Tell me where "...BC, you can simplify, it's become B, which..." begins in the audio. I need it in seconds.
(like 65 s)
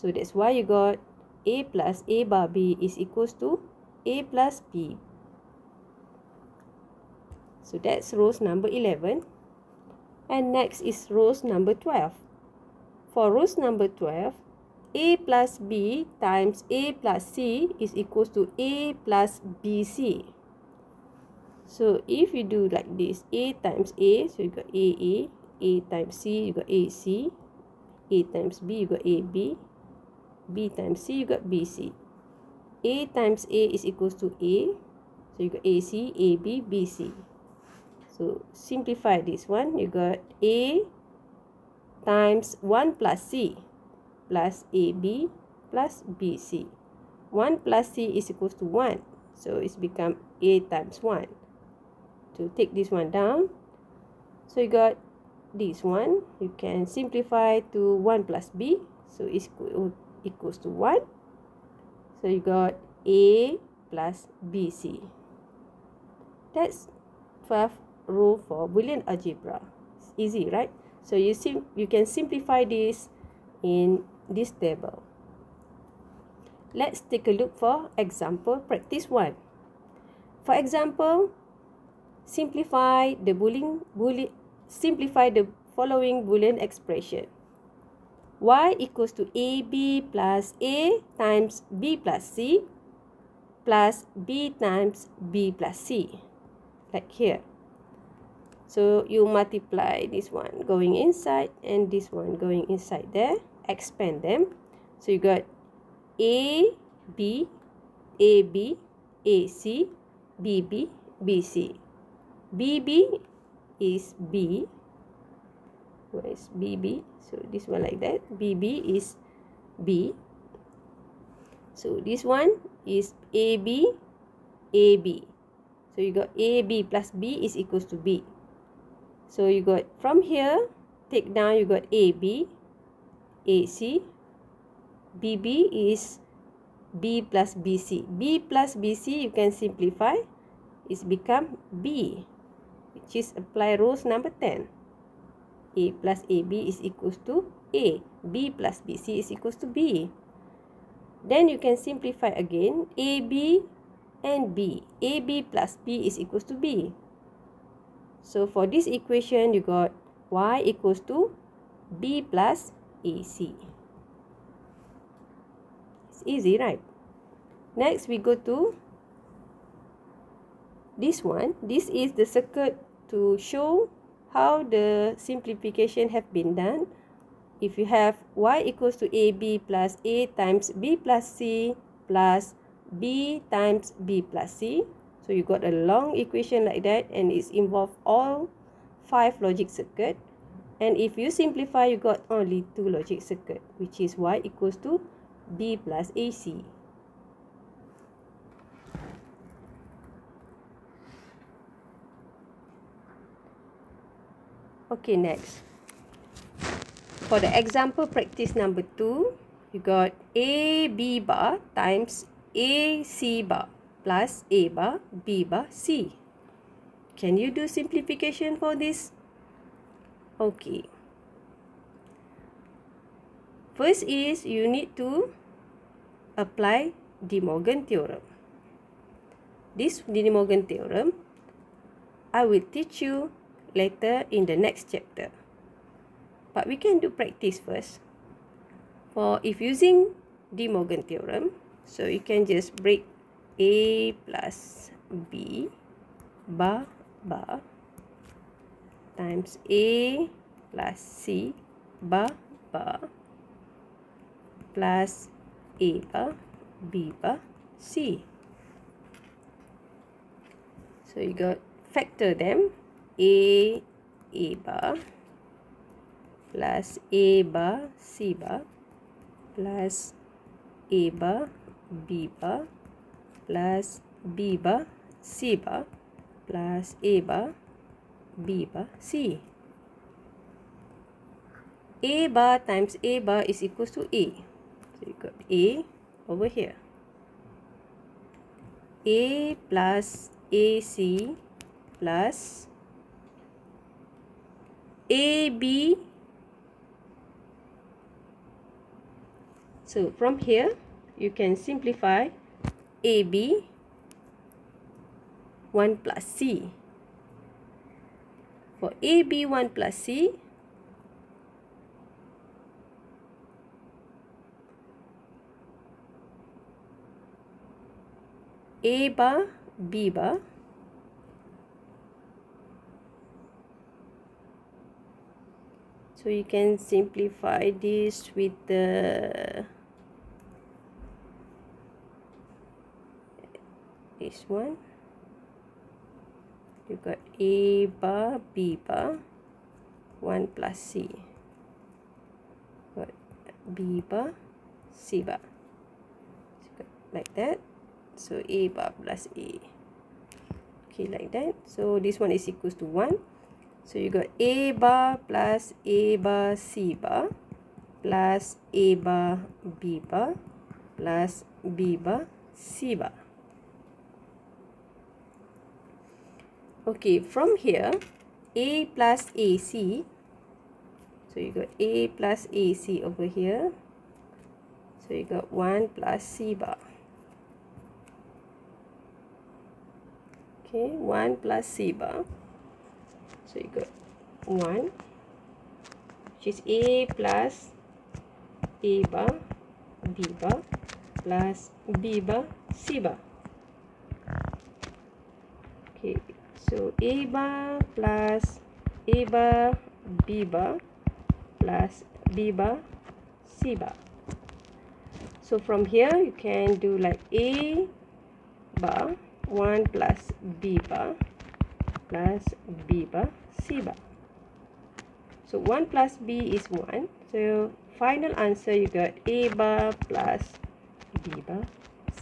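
138 s.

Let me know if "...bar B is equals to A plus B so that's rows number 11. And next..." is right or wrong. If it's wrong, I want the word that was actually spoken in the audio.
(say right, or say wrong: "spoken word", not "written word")
right.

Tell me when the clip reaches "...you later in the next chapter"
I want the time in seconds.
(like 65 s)
233 s.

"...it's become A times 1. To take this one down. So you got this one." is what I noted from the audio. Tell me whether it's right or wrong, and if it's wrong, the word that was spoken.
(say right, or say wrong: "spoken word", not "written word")
right.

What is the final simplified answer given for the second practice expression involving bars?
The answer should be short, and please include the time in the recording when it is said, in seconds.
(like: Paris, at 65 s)
A bar plus B bar, at 419 s.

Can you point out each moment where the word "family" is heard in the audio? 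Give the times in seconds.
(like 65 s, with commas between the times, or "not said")
not said.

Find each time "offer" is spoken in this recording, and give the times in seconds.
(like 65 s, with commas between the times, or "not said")
not said.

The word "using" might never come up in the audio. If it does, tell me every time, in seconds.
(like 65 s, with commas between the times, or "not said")
239 s.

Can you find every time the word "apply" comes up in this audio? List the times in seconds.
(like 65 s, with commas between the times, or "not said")
143 s, 226 s.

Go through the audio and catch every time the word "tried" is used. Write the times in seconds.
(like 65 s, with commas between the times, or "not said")
not said.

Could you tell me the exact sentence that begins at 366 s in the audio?
Okay, from here, A plus AC.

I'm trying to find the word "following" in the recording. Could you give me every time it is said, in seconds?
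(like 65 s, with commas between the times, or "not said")
85 s.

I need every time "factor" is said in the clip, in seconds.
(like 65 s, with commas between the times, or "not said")
261 s.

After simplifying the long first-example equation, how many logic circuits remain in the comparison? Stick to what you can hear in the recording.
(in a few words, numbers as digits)
2.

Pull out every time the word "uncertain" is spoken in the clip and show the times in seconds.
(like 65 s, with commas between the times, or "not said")
not said.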